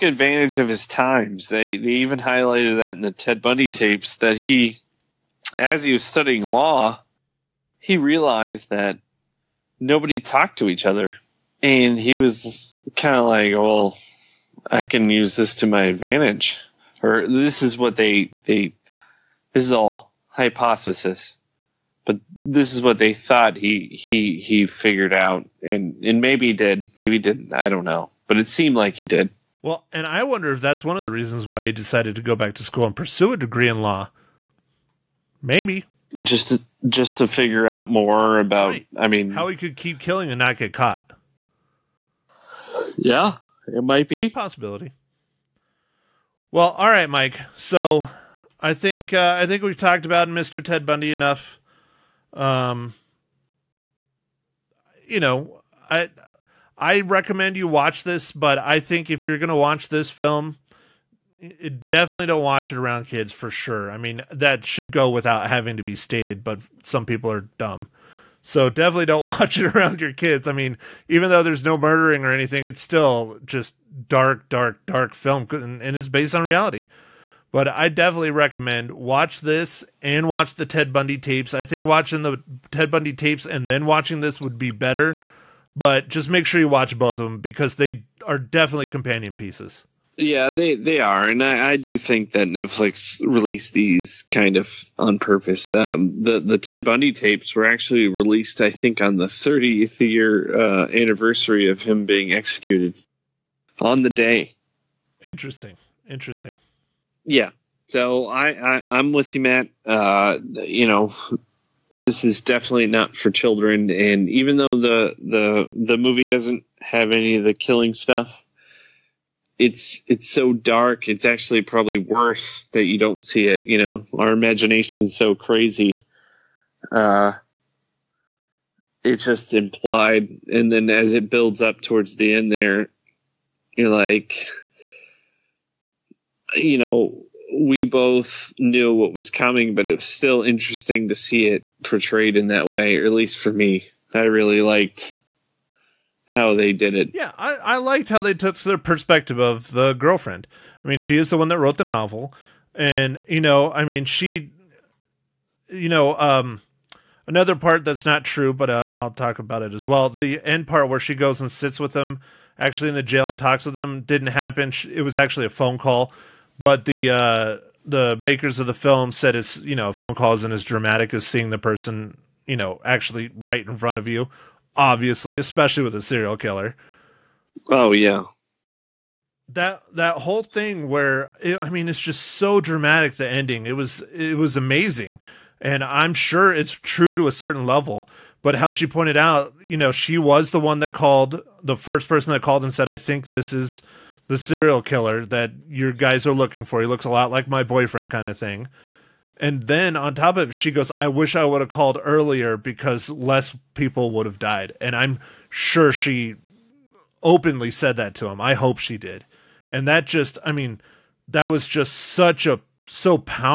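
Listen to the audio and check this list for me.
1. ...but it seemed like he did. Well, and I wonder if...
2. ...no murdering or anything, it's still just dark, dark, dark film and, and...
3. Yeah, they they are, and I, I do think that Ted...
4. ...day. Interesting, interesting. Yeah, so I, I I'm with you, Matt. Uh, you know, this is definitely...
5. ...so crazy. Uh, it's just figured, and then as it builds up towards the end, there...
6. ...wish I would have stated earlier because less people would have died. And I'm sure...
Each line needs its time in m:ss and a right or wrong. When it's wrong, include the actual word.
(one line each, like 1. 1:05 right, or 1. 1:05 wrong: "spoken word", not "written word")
1. 0:28 right
2. 1:11 right
3. 1:30 wrong: "Netflix", not "Ted"
4. 1:44 right
5. 2:05 wrong: "implied", not "figured"
6. 3:21 wrong: "called", not "stated".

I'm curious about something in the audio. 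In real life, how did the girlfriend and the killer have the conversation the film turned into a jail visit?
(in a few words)
a phone call.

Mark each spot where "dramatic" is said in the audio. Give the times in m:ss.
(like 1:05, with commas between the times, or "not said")
2:50, 3:02.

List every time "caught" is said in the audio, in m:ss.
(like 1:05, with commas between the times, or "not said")
0:40.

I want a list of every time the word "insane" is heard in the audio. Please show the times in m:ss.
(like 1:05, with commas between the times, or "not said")
not said.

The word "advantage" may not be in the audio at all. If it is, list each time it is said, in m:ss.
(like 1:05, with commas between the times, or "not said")
0:00, 0:15.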